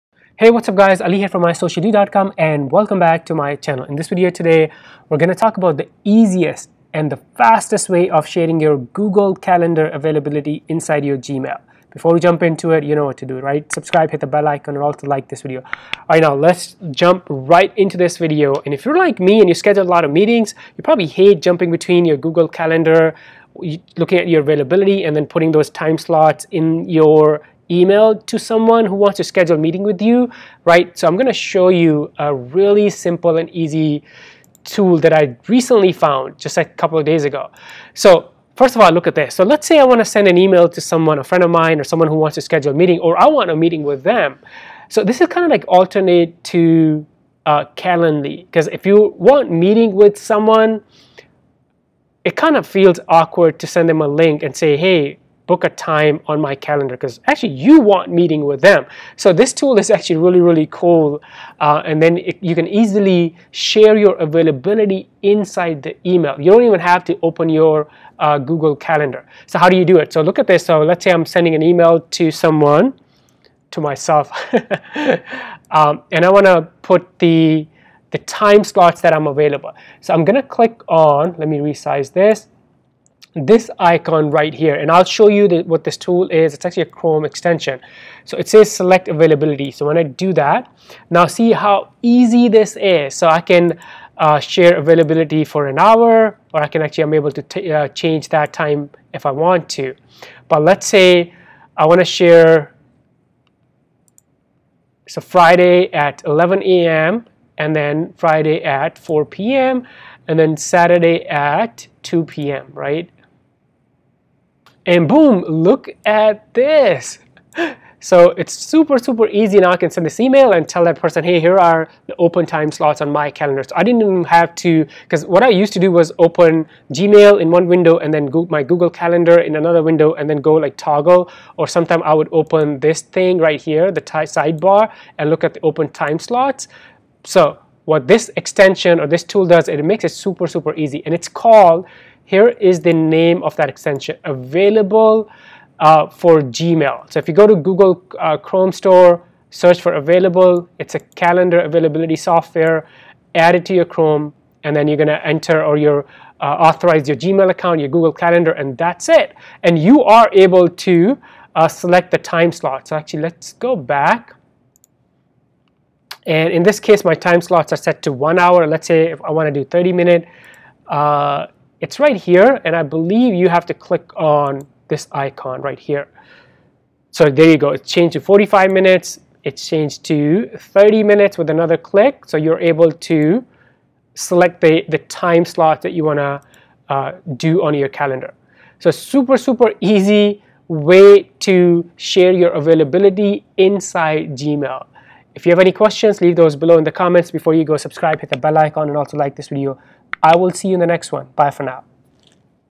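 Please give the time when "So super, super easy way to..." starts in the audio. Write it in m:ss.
3:08.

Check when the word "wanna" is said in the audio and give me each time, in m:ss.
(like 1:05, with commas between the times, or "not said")
0:39, 3:06.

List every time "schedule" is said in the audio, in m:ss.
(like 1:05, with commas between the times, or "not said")
0:19, 0:29, 0:42.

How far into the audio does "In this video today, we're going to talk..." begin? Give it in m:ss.
0:03.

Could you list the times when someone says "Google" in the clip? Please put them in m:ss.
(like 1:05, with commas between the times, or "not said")
0:08, 0:22, 1:08, 2:08, 2:27, 2:37.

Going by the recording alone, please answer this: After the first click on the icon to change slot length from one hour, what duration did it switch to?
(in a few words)
45 minutes.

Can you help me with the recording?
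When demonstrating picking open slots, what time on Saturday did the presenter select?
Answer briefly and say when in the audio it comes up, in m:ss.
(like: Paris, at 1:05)
2 p.m., at 1:50.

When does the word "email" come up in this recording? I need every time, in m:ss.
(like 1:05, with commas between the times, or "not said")
0:27, 0:40, 1:06, 1:11, 2:00.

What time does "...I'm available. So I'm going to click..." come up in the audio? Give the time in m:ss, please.
1:19.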